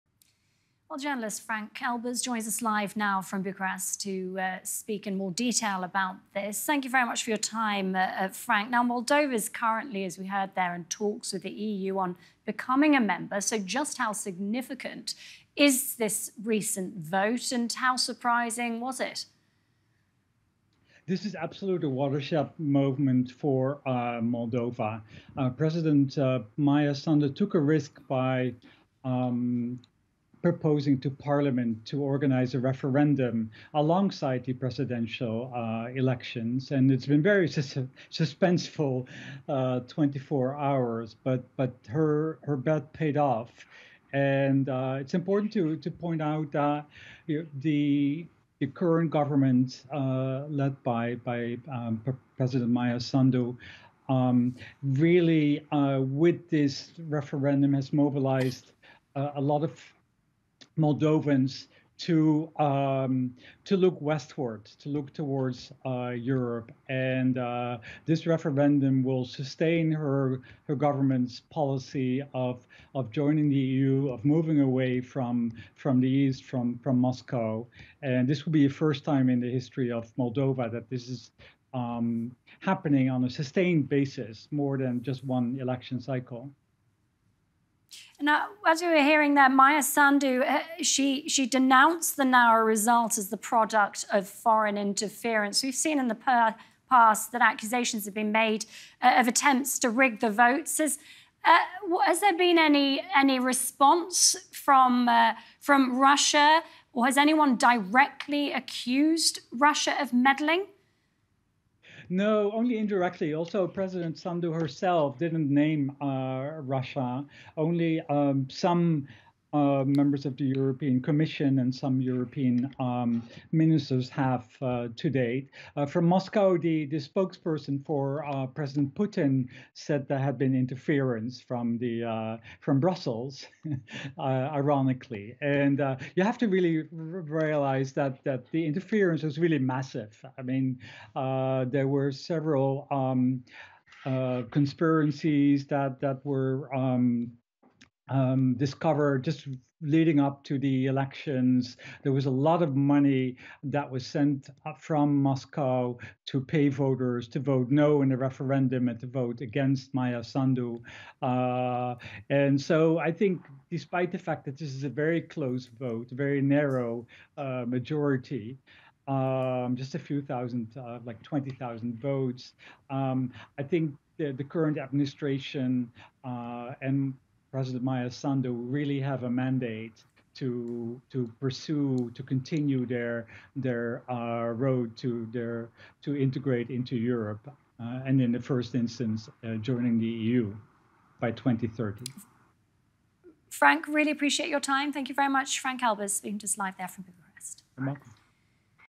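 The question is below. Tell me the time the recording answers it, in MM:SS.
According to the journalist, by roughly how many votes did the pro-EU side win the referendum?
02:51.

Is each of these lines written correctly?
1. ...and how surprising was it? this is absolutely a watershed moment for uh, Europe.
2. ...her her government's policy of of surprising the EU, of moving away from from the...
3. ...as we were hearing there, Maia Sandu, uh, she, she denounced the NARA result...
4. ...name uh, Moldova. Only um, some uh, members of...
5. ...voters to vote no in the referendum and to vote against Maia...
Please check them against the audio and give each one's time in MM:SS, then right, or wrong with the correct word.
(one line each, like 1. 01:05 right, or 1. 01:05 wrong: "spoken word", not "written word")
1. 00:17 wrong: "Moldova", not "Europe"
2. 01:09 wrong: "joining", not "surprising"
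3. 01:28 right
4. 01:55 wrong: "Russia", not "Moldova"
5. 02:36 right.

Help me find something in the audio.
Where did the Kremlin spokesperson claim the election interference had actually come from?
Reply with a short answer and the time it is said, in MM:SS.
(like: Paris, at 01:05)
Brussels, at 02:12.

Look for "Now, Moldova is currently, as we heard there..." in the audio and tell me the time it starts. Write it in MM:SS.
00:08.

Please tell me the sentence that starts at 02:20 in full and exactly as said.
I mean, there were several um, conspiracies that that were.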